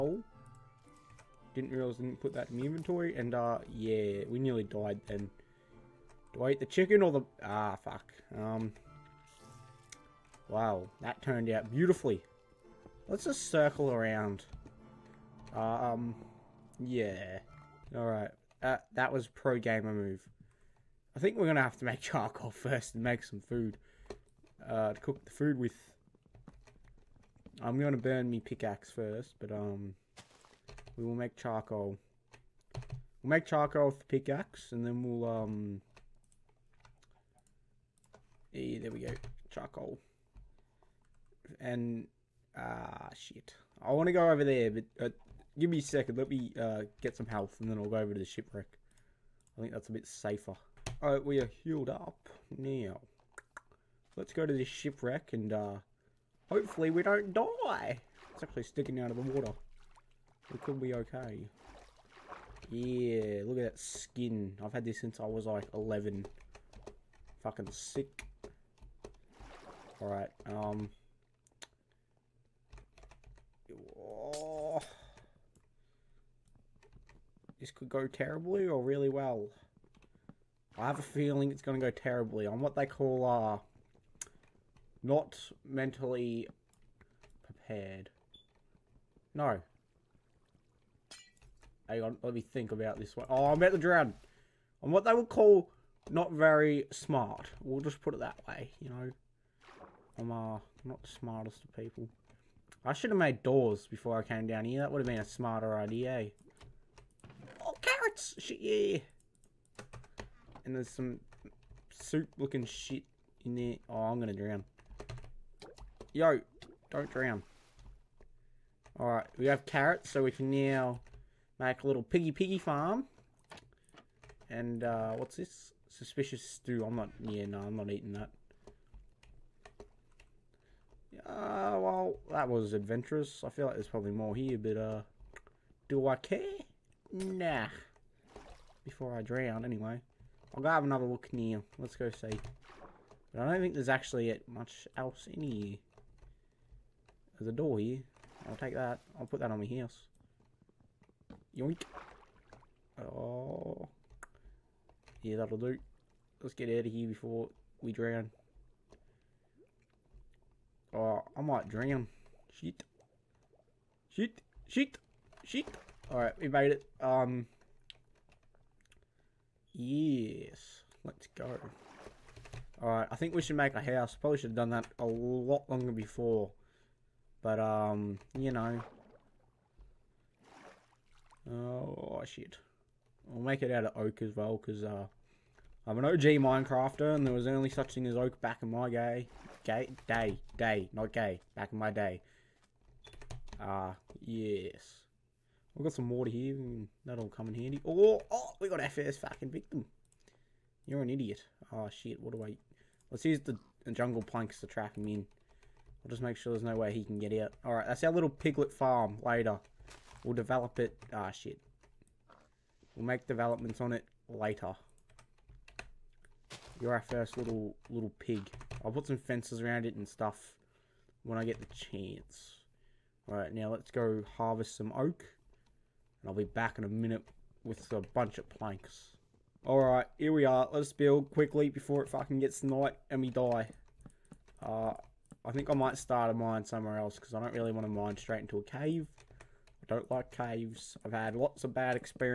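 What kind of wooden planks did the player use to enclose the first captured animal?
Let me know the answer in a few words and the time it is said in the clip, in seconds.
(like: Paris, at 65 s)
Jungle planks, at 203 s.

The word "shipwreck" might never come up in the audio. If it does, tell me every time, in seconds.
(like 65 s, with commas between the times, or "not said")
48 s, 54 s.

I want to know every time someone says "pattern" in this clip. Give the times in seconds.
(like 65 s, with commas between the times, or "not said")
not said.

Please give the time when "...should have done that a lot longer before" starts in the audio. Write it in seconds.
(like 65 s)
174 s.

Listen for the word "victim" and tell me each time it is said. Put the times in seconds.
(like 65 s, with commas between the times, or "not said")
199 s.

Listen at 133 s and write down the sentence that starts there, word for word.
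I feel like there's probably more here, but, uh, do I care?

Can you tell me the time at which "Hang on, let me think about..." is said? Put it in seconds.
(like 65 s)
91 s.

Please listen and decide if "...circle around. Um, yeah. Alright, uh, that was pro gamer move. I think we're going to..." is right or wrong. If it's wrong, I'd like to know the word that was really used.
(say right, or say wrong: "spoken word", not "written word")
right.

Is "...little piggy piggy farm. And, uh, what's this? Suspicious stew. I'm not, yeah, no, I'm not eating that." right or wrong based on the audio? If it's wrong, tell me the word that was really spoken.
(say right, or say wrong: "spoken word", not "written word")
right.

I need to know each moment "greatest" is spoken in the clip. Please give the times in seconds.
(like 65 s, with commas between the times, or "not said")
not said.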